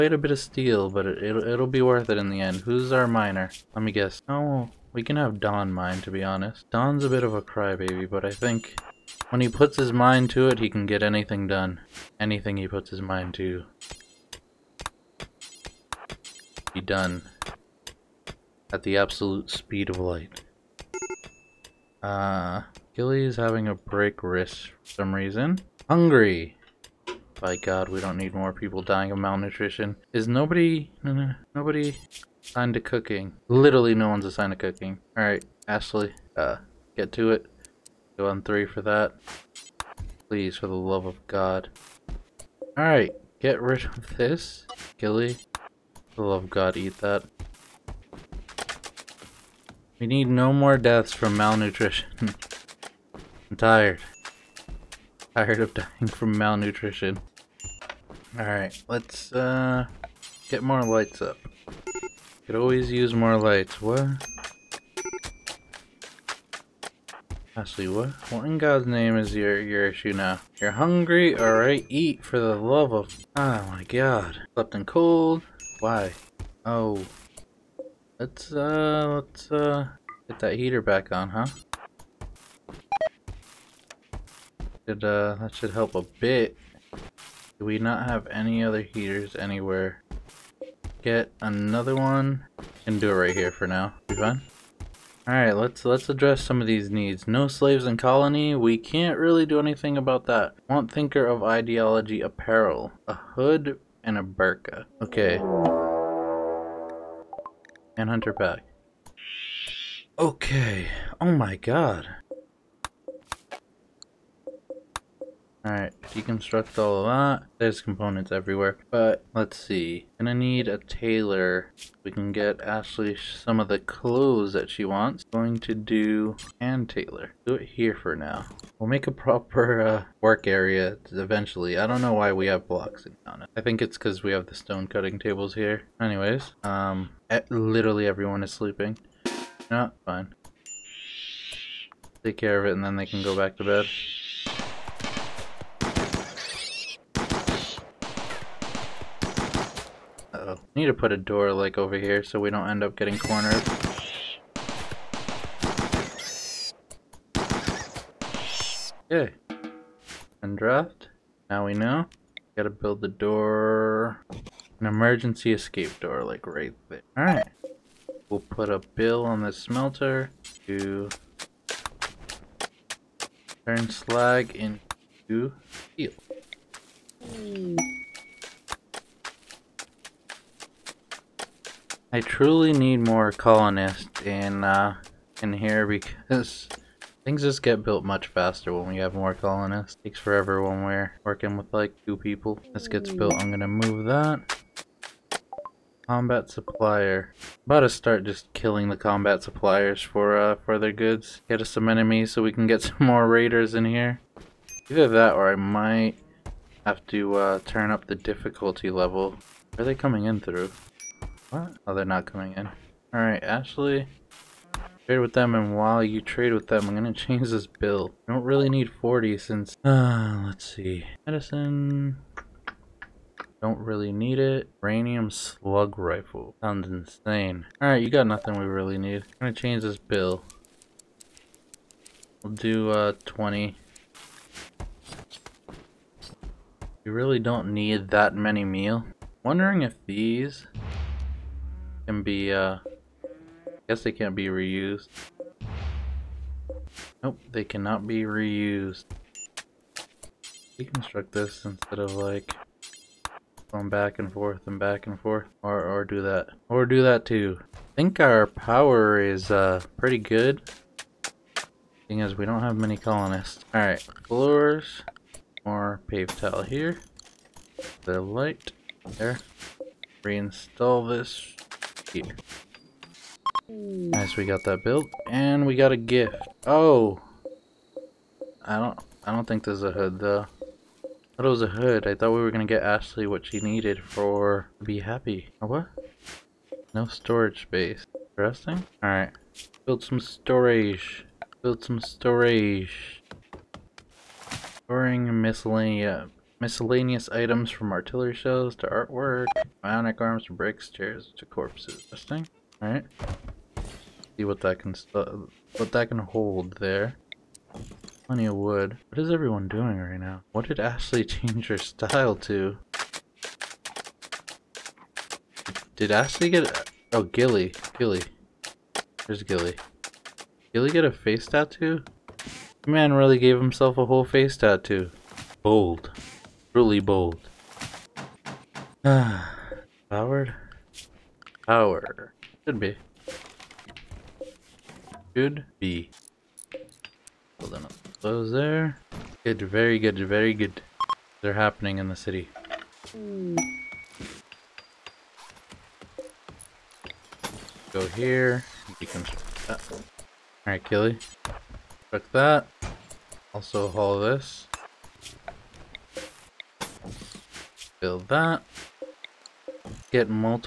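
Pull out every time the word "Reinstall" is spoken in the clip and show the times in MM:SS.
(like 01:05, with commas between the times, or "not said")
04:30.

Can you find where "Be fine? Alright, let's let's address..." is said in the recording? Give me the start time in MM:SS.
01:34.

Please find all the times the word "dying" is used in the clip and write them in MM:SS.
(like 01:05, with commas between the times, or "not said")
00:28, 00:55.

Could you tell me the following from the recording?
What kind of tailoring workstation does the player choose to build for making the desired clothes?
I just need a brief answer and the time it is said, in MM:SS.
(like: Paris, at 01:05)
Hand tailor, at 02:06.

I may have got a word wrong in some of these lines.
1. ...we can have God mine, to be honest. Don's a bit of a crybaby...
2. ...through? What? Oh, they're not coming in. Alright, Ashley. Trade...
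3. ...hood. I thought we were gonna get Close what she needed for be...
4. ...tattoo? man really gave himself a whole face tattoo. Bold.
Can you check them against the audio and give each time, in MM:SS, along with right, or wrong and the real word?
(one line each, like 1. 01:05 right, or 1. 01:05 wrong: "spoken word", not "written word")
1. 00:04 wrong: "Don", not "God"
2. 03:30 right
3. 04:41 wrong: "Ashley", not "Close"
4. 05:21 right.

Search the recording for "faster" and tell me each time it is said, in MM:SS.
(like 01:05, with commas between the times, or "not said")
03:08.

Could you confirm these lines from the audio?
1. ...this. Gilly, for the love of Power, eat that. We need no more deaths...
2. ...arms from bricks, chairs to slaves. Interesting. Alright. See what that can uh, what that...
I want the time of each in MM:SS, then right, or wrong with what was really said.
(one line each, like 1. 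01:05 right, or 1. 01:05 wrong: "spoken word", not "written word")
1. 00:44 wrong: "God", not "Power"
2. 05:00 wrong: "corpses", not "slaves".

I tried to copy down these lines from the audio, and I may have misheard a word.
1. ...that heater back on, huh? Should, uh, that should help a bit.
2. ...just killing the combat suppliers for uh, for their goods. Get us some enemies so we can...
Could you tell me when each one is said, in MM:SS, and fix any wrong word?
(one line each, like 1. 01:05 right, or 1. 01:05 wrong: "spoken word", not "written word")
1. 01:20 right
2. 03:18 right.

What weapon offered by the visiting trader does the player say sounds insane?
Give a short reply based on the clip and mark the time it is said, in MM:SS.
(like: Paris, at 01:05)
Uranium slug rifle, at 03:44.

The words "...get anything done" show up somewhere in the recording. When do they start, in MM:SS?
00:10.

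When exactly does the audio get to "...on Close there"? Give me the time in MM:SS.
05:37.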